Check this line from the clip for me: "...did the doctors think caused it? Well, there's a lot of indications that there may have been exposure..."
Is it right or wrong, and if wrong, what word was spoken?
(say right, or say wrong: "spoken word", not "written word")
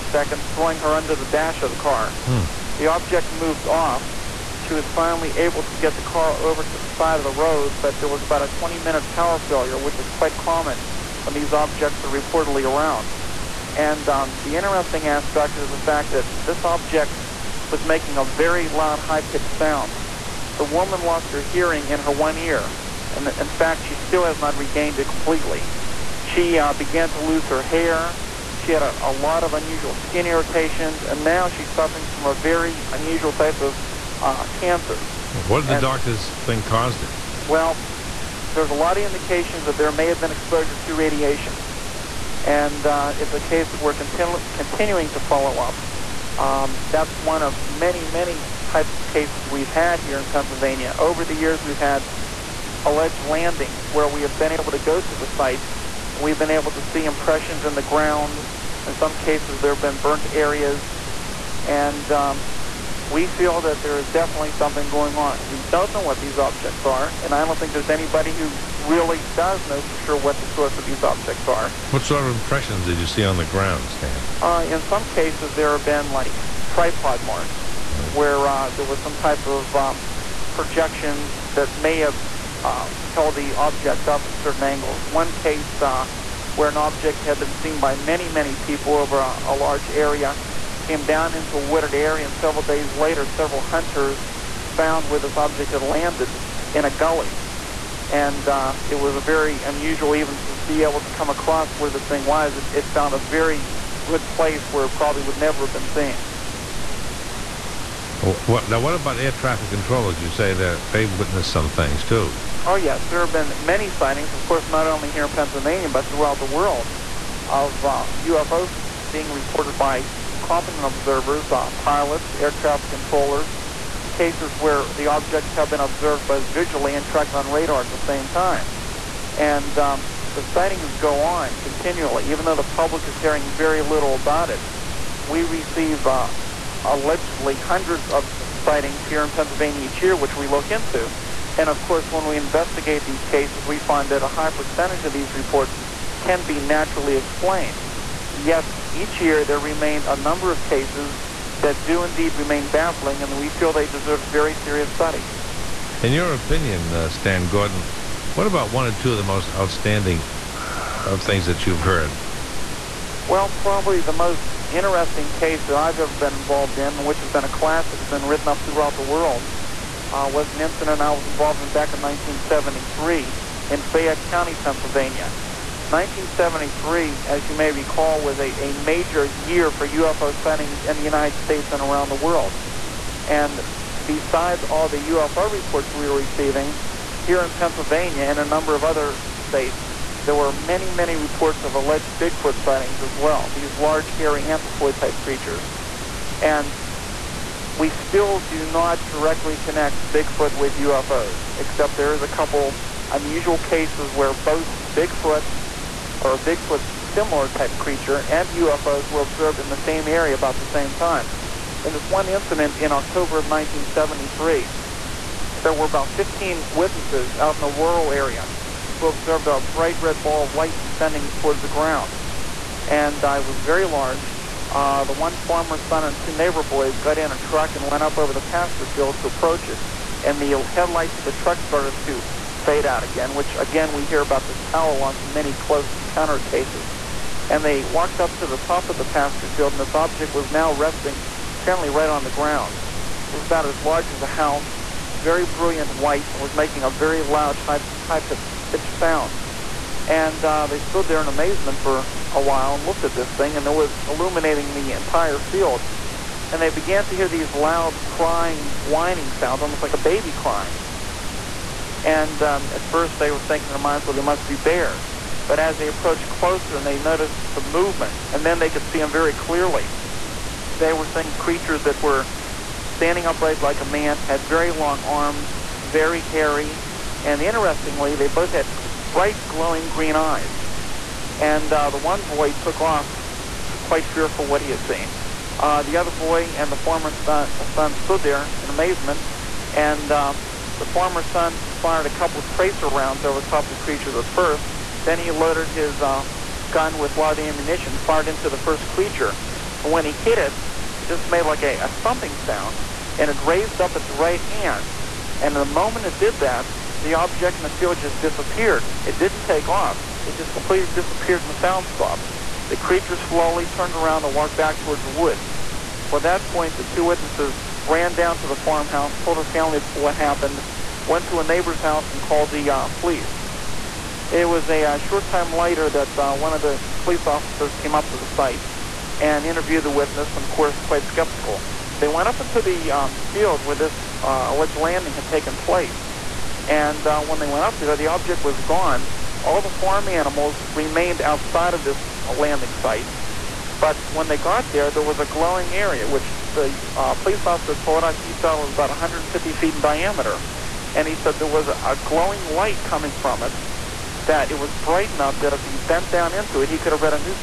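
right.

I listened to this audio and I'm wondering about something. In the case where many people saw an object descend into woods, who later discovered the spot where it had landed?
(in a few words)
hunters.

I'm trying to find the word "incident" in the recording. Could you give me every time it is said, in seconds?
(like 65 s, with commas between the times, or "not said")
170 s, 212 s.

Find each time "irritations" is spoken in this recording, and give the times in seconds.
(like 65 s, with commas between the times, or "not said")
30 s.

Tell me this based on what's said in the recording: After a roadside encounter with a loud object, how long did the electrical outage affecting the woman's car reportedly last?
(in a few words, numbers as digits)
20 minutes.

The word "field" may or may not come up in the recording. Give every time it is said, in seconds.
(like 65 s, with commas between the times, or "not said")
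228 s, 239 s, 255 s, 307 s, 333 s.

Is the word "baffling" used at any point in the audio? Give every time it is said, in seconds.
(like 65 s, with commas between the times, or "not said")
152 s.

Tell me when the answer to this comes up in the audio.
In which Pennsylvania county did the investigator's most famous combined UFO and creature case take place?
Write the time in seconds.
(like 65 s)
173 s.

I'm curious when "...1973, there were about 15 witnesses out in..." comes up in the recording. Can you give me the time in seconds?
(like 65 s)
213 s.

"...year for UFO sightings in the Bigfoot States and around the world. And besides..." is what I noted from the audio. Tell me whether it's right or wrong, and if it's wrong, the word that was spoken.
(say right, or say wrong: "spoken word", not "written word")
wrong: "United", not "Bigfoot".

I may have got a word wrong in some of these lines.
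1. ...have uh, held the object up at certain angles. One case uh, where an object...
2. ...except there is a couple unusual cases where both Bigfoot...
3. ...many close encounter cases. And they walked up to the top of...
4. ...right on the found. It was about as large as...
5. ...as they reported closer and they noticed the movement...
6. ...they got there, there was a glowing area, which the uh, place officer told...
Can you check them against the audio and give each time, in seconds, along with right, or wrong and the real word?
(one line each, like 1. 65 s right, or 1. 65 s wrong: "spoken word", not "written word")
1. 81 s right
2. 201 s right
3. 235 s right
4. 241 s wrong: "ground", not "found"
5. 265 s wrong: "approached", not "reported"
6. 344 s wrong: "police", not "place".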